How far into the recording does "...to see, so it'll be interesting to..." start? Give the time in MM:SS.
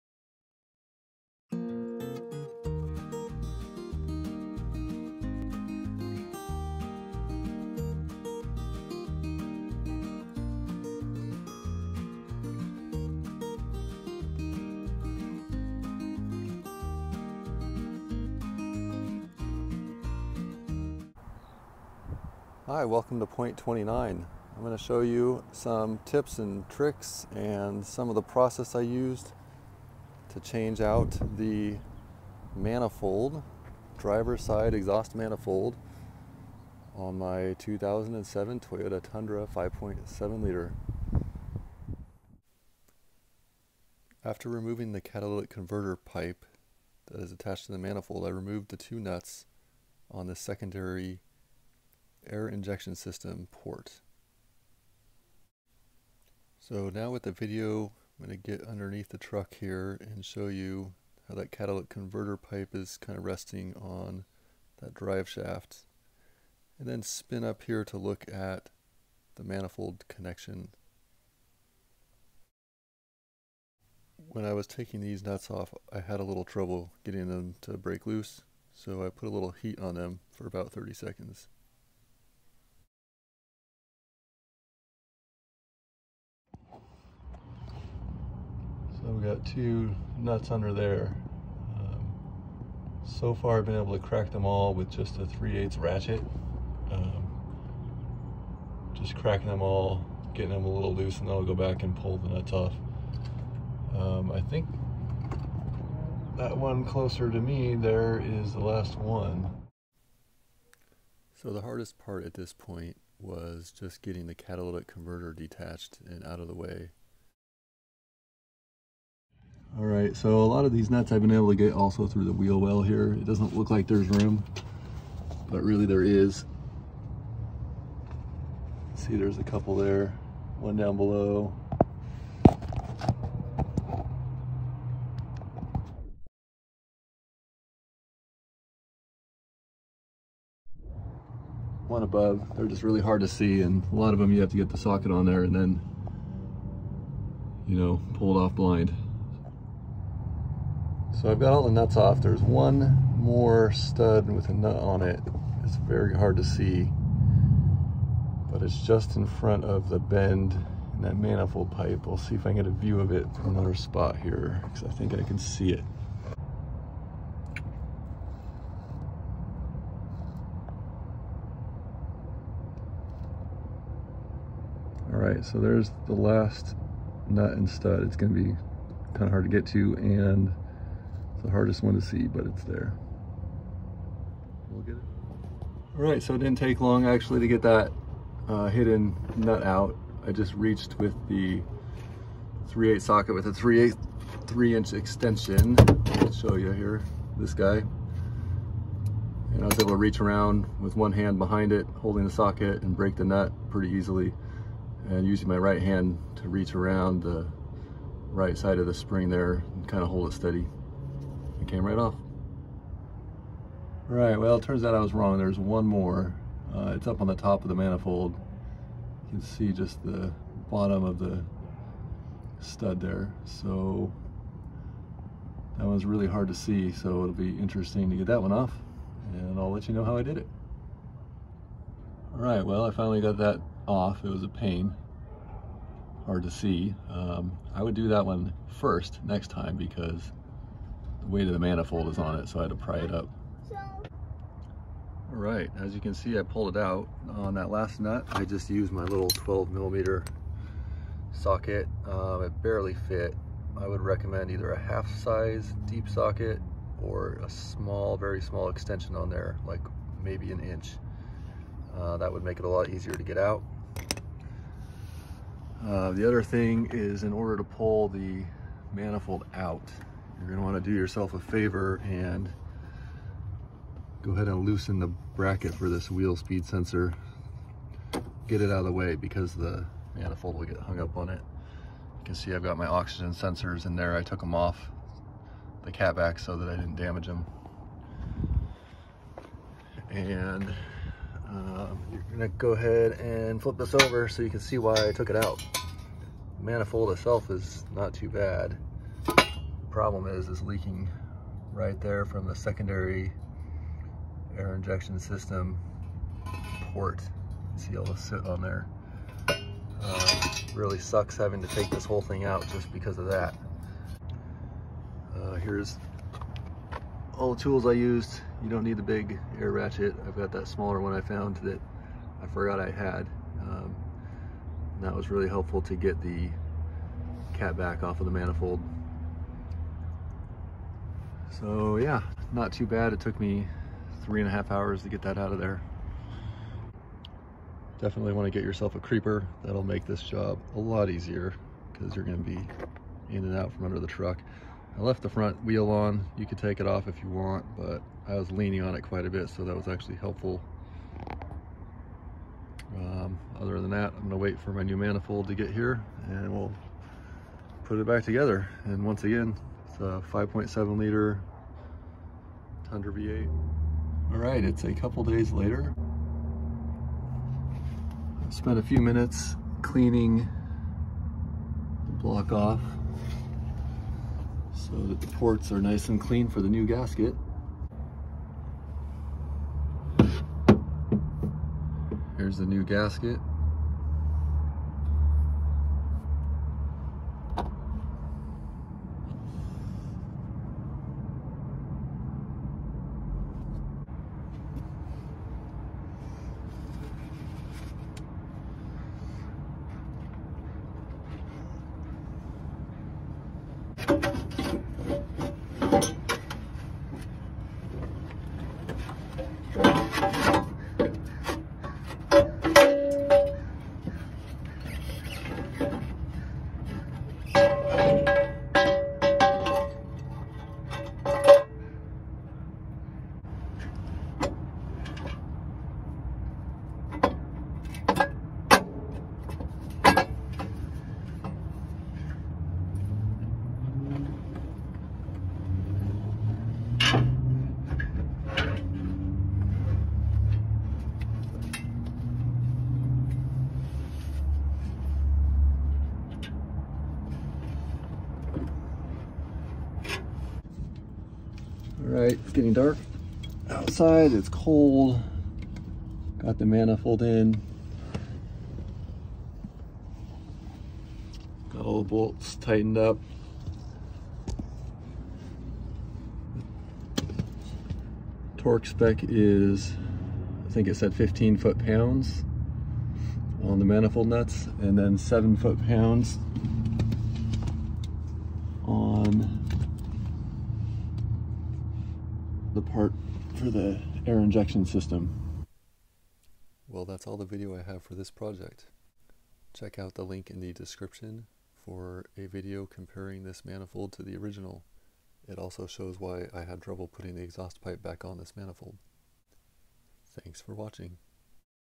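03:46.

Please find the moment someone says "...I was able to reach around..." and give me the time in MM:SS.
03:19.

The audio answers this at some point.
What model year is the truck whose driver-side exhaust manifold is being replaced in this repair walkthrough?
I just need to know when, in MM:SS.
00:37.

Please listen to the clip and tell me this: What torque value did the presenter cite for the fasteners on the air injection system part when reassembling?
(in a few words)
7 foot-pounds.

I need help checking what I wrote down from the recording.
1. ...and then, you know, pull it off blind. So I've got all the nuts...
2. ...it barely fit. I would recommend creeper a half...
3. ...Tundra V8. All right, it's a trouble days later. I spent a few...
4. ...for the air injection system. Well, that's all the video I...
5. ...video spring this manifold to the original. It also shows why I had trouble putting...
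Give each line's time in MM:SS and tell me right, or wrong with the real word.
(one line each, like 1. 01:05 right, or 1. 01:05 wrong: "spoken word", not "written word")
1. 02:25 right
2. 04:12 wrong: "either", not "creeper"
3. 06:02 wrong: "couple", not "trouble"
4. 08:03 right
5. 08:12 wrong: "comparing", not "spring".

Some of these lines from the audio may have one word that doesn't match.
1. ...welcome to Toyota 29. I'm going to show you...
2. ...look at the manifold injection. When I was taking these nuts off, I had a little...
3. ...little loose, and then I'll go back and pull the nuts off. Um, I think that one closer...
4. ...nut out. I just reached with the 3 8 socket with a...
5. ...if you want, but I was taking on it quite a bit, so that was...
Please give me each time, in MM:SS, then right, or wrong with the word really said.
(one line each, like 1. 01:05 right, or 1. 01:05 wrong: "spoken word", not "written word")
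1. 00:22 wrong: "Point", not "Toyota"
2. 01:07 wrong: "connection", not "injection"
3. 01:40 right
4. 03:09 right
5. 05:47 wrong: "leaning", not "taking".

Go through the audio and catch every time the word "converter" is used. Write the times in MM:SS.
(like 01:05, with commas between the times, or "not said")
00:45, 01:01, 01:54.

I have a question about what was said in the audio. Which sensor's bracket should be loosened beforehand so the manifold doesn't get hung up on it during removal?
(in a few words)
wheel speed sensor.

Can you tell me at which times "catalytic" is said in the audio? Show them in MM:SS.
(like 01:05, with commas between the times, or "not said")
00:45, 01:01, 01:54.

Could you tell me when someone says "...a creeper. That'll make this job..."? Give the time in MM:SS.
05:38.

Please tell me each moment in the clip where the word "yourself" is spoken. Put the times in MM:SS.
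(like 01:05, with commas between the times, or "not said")
04:30, 05:38.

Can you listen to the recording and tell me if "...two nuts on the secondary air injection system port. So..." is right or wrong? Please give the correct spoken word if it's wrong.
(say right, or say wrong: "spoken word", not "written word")
right.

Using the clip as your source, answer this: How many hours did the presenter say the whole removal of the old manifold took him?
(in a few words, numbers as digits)
3.5 hours.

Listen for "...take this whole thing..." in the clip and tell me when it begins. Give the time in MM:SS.
05:11.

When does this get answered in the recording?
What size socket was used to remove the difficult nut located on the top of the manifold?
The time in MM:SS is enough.
04:09.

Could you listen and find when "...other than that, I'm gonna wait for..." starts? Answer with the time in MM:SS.
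05:53.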